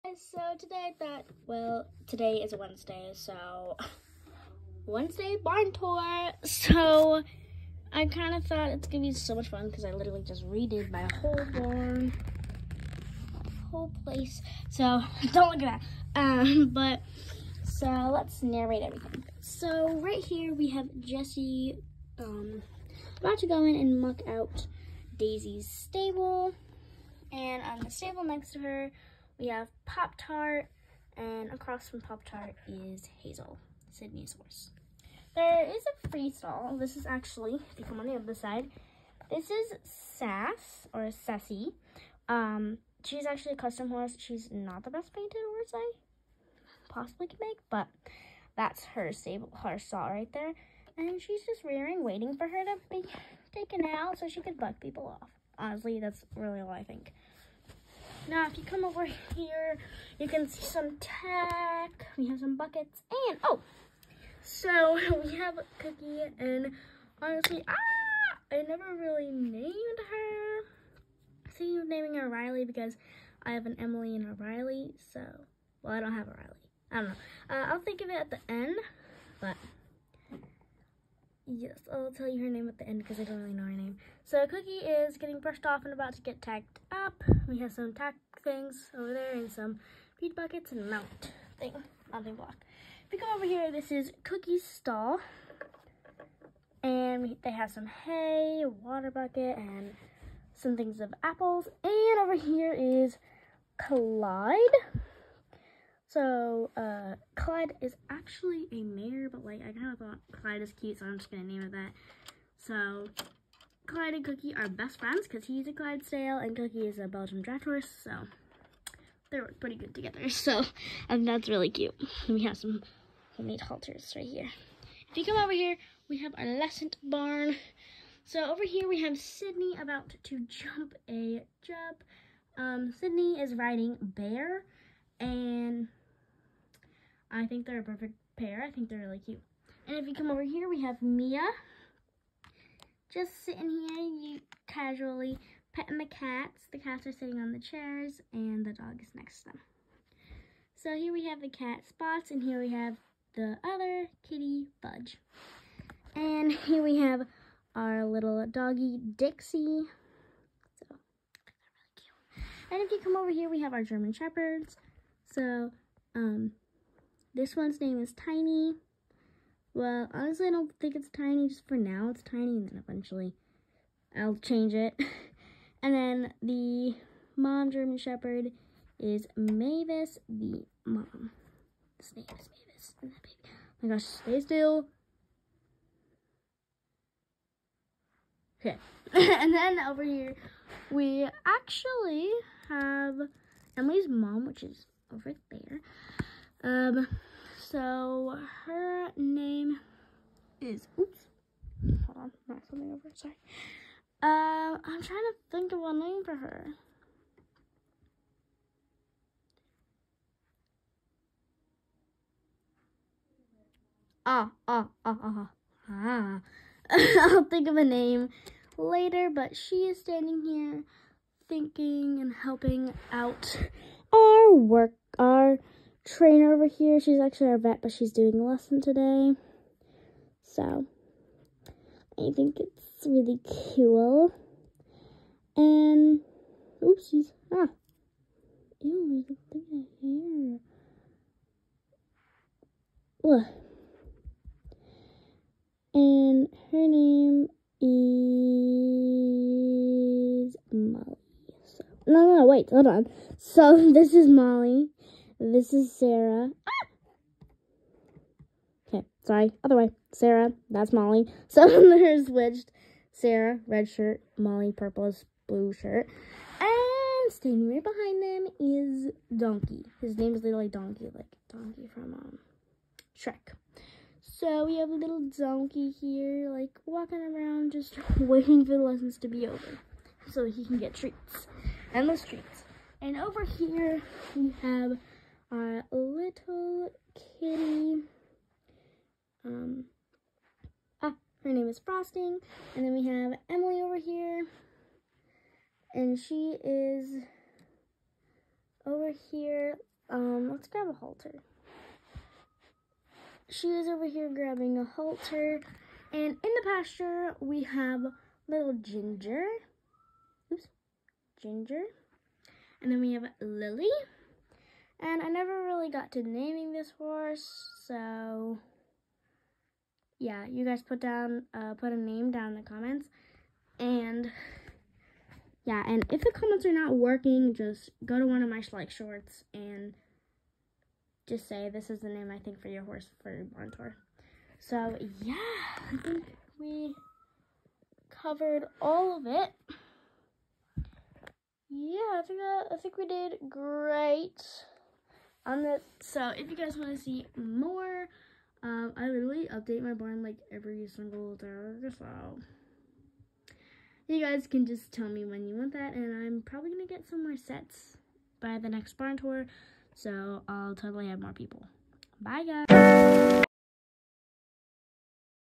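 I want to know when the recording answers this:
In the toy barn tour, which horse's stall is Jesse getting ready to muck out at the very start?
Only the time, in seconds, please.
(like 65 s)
25 s.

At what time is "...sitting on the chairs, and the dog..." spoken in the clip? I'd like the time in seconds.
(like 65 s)
147 s.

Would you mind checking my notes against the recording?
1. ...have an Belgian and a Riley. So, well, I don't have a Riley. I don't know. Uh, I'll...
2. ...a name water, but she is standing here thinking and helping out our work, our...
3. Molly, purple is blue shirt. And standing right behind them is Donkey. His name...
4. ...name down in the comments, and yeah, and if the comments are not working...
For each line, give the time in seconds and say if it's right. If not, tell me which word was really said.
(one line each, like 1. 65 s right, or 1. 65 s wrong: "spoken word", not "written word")
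1. 73 s wrong: "Emily", not "Belgian"
2. 217 s wrong: "later", not "water"
3. 264 s right
4. 321 s right.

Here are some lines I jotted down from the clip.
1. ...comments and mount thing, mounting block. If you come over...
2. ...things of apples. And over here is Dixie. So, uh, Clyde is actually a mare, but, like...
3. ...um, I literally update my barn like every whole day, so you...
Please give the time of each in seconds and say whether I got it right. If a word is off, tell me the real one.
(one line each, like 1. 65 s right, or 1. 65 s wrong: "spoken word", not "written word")
1. 90 s wrong: "buckets", not "comments"
2. 100 s wrong: "Clyde", not "Dixie"
3. 348 s wrong: "single", not "whole".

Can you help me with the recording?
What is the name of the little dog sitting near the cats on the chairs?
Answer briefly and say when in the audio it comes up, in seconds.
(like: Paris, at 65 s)
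Dixie, at 159 s.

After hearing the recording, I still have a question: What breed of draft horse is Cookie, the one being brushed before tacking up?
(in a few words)
Belgian.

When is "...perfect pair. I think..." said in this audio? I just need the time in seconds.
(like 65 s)
137 s.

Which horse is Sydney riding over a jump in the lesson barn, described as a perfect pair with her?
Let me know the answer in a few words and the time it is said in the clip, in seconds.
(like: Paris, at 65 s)
Bear, at 134 s.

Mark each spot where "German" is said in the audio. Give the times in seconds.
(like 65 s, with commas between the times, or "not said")
163 s, 177 s.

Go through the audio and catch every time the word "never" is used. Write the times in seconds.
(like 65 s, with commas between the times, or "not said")
68 s, 315 s.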